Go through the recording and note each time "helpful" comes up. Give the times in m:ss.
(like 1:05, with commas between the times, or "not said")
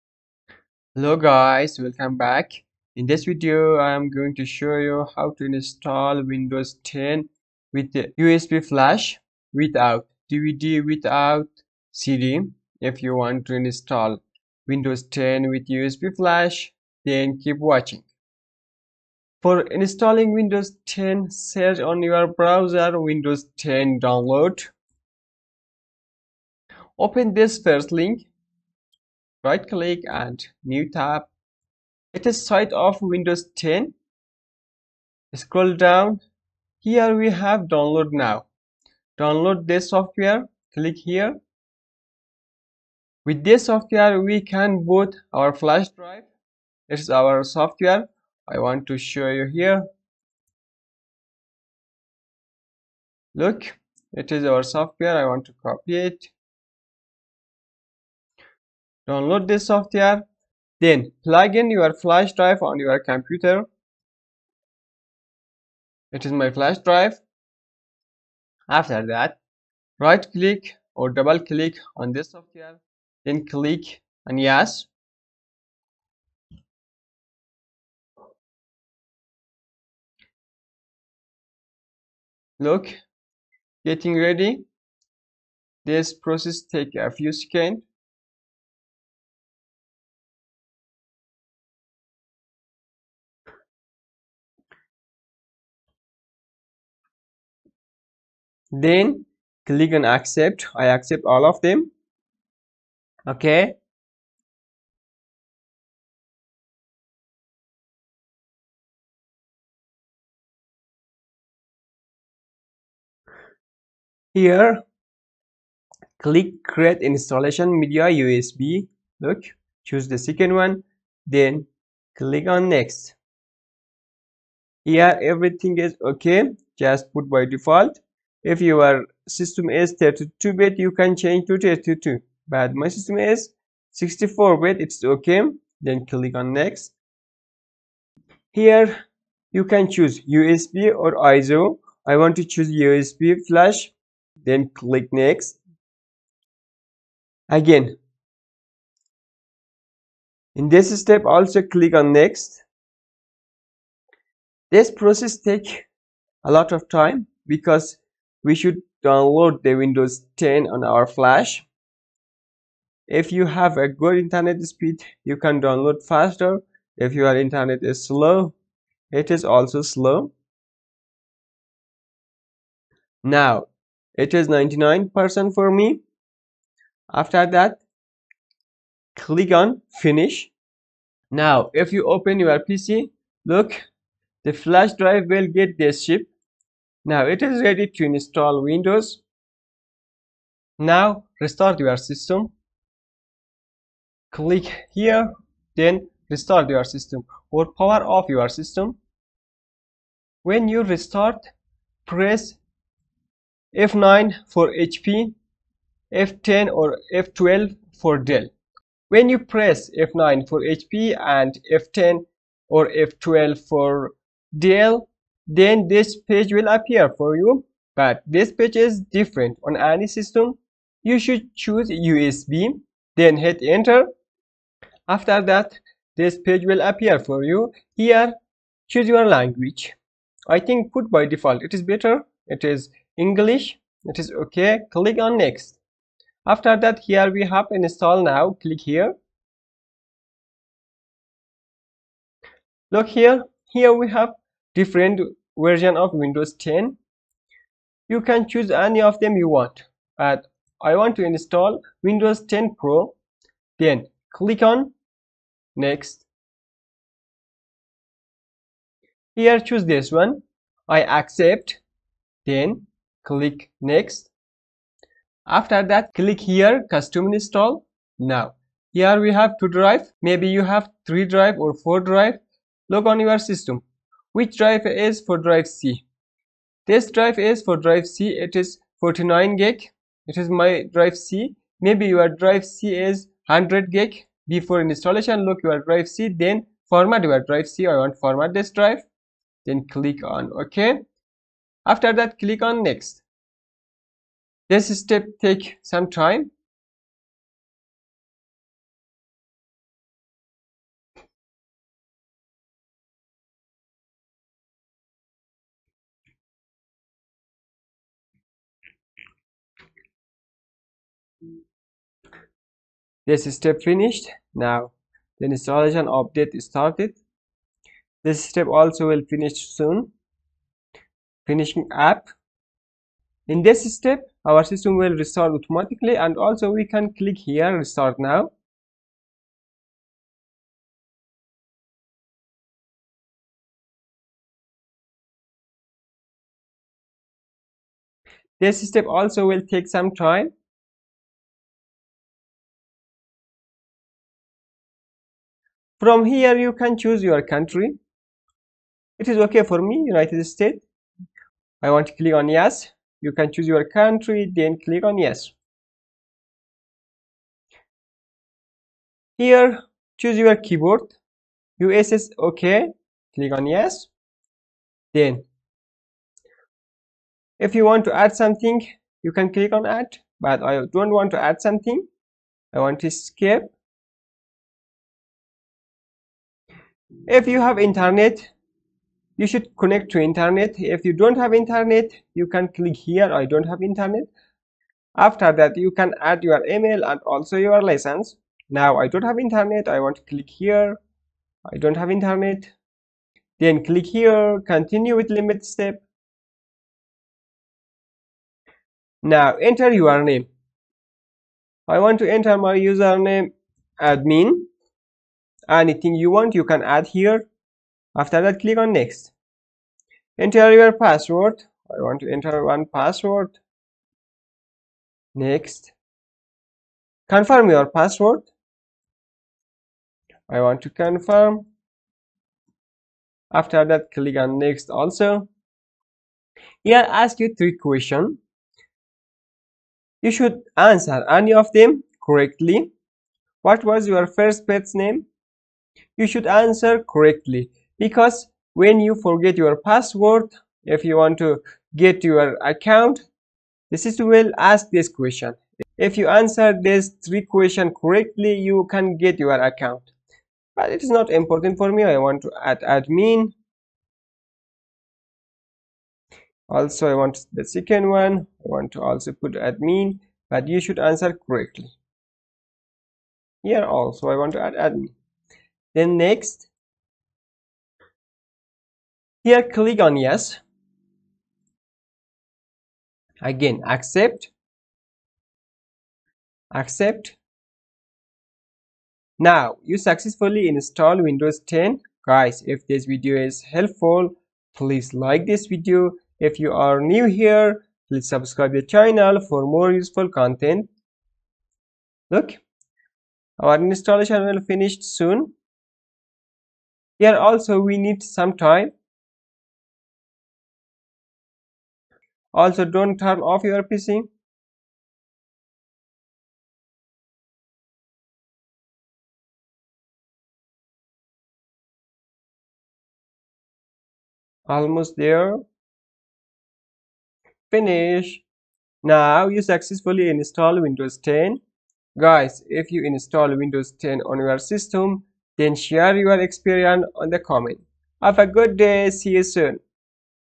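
8:03.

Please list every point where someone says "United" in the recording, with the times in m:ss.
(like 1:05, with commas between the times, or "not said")
5:50.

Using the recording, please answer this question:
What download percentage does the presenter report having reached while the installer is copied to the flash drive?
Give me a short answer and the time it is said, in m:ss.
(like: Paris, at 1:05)
99%, at 2:54.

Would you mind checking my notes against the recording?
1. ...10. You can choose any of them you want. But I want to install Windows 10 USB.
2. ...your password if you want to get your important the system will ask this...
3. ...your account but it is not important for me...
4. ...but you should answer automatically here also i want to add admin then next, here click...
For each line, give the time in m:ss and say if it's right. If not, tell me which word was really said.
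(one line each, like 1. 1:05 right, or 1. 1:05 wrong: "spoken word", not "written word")
1. 4:06 wrong: "Pro", not "USB"
2. 7:19 wrong: "account", not "important"
3. 7:29 right
4. 7:40 wrong: "correctly", not "automatically".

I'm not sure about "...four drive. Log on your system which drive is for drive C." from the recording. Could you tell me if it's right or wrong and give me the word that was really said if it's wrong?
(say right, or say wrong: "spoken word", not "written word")
right.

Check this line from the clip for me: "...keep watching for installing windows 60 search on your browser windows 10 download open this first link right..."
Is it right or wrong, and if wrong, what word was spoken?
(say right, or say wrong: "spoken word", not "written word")
wrong: "10", not "60".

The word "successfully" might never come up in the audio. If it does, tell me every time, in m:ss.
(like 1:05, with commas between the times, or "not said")
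7:59, 8:39.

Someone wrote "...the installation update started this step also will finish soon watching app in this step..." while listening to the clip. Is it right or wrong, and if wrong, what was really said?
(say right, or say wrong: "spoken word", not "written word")
wrong: "finishing", not "watching".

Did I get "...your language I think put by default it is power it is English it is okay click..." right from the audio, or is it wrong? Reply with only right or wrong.
wrong.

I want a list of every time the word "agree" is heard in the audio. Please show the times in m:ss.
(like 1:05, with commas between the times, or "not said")
not said.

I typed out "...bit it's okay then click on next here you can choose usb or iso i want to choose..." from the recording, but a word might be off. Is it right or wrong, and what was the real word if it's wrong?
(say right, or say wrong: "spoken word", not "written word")
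right.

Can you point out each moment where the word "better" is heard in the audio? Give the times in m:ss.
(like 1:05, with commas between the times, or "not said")
3:51.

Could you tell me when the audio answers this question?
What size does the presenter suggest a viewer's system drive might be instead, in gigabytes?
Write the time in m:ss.
4:43.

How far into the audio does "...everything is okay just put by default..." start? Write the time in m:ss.
2:05.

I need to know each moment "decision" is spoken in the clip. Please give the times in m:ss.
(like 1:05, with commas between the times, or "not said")
not said.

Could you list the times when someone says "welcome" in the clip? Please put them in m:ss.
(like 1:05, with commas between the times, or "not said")
0:01.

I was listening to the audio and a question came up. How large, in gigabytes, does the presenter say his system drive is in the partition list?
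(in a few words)
49.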